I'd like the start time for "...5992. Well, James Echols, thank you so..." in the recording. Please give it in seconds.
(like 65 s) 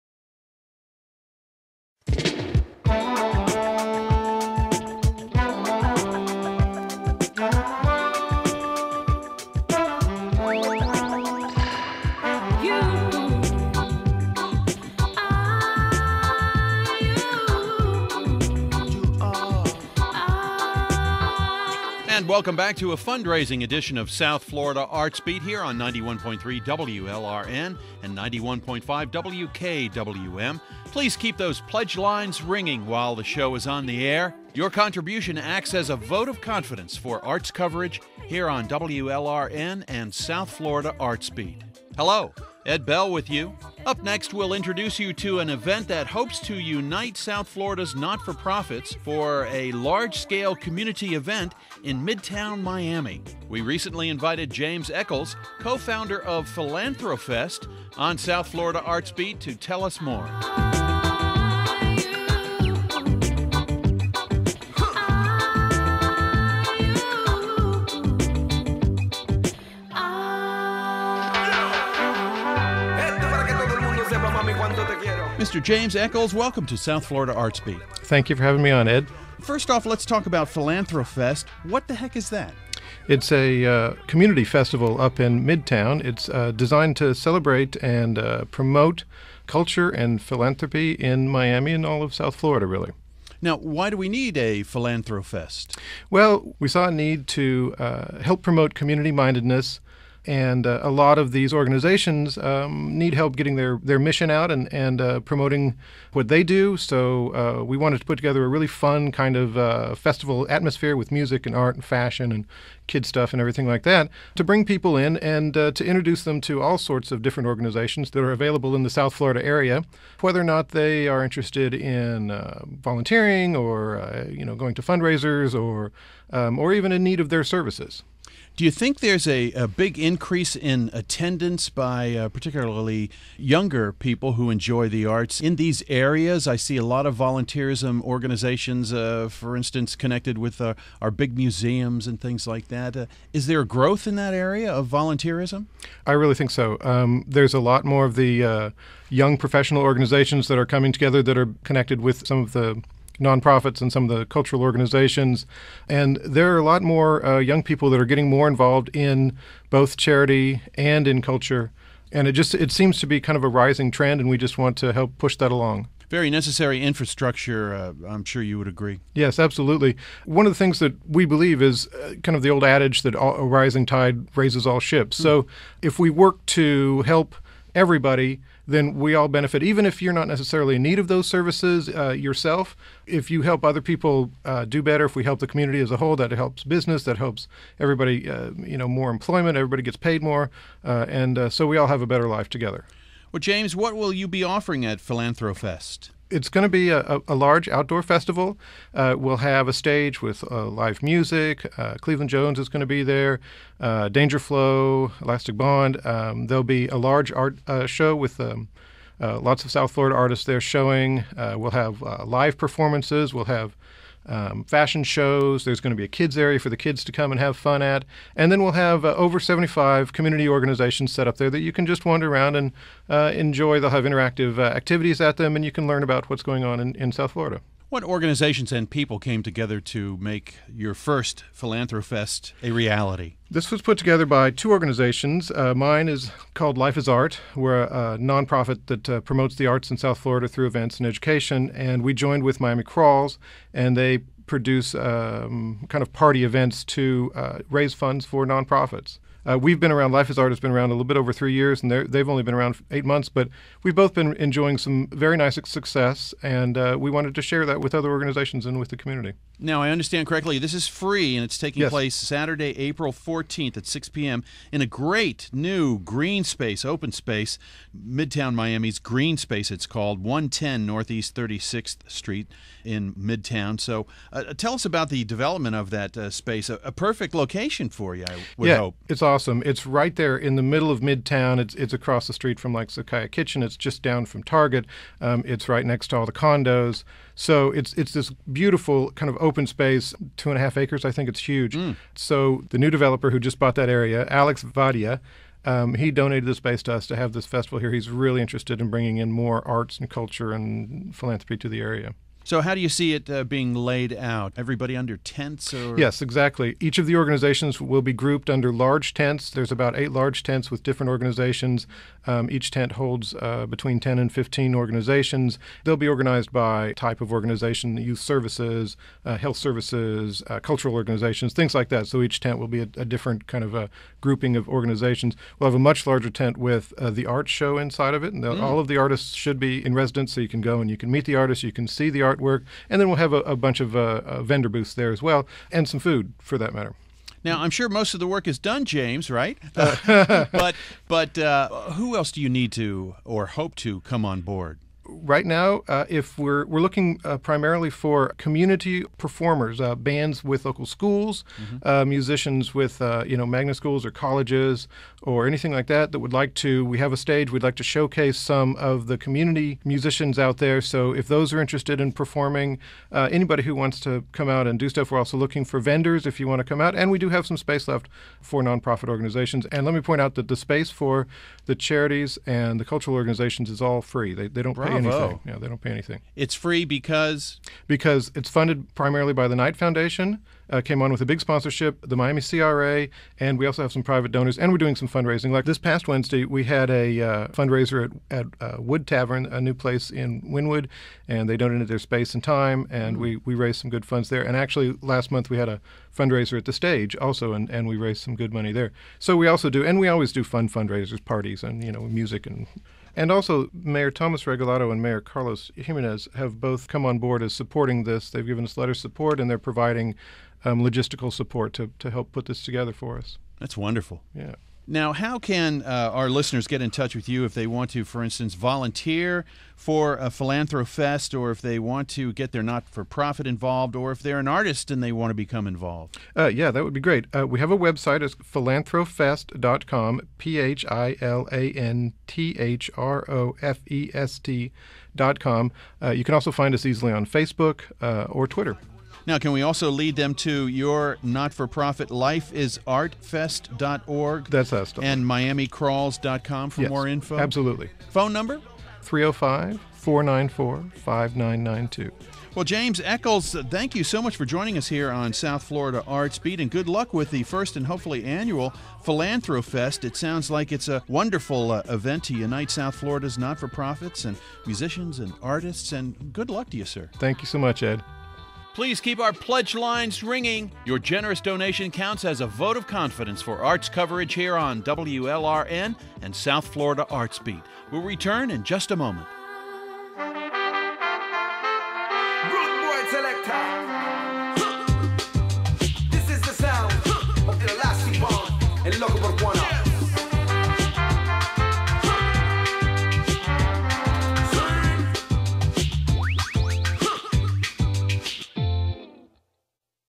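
450 s.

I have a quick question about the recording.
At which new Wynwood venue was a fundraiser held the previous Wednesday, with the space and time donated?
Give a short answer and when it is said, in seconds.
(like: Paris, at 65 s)
Wood Tavern, at 388 s.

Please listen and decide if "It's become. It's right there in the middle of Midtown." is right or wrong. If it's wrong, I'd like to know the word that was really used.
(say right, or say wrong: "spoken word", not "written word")
wrong: "awesome", not "become".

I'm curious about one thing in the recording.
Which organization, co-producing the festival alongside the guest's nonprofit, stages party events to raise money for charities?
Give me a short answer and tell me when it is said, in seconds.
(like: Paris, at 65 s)
Miami Crawls, at 242 s.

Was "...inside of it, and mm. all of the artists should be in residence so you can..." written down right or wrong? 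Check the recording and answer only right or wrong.
right.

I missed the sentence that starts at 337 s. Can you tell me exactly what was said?
Now, I'm sure most of the work is done, James, right?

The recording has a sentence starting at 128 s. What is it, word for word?
Do you think there's a, a big increase in attendance by uh, particularly younger people who enjoy the arts in these areas?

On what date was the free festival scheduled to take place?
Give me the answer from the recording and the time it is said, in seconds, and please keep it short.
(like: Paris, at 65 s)
Saturday, April 14th, at 262 s.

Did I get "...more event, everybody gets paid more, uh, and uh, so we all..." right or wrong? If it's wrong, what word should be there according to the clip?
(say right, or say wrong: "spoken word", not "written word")
wrong: "employment", not "event".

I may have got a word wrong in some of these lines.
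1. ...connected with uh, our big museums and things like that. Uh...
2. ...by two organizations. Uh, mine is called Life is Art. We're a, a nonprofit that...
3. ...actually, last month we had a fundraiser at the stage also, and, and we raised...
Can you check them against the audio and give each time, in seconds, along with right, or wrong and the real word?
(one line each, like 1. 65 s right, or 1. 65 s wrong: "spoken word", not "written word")
1. 139 s right
2. 234 s right
3. 394 s right.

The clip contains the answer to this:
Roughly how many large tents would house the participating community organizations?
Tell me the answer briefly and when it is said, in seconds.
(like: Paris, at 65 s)
8, at 309 s.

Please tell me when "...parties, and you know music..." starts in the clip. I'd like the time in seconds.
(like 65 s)
401 s.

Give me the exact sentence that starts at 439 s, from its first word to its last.
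Now, can we also lead them to your not for profit lifeisartfest.org?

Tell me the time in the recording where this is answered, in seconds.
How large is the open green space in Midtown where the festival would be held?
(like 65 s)
290 s.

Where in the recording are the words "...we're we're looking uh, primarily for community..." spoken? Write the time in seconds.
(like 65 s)
346 s.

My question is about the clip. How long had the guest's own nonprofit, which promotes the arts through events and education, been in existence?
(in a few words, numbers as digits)
a little over 3 years.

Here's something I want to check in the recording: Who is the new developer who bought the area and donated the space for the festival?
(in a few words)
Alex Vadia.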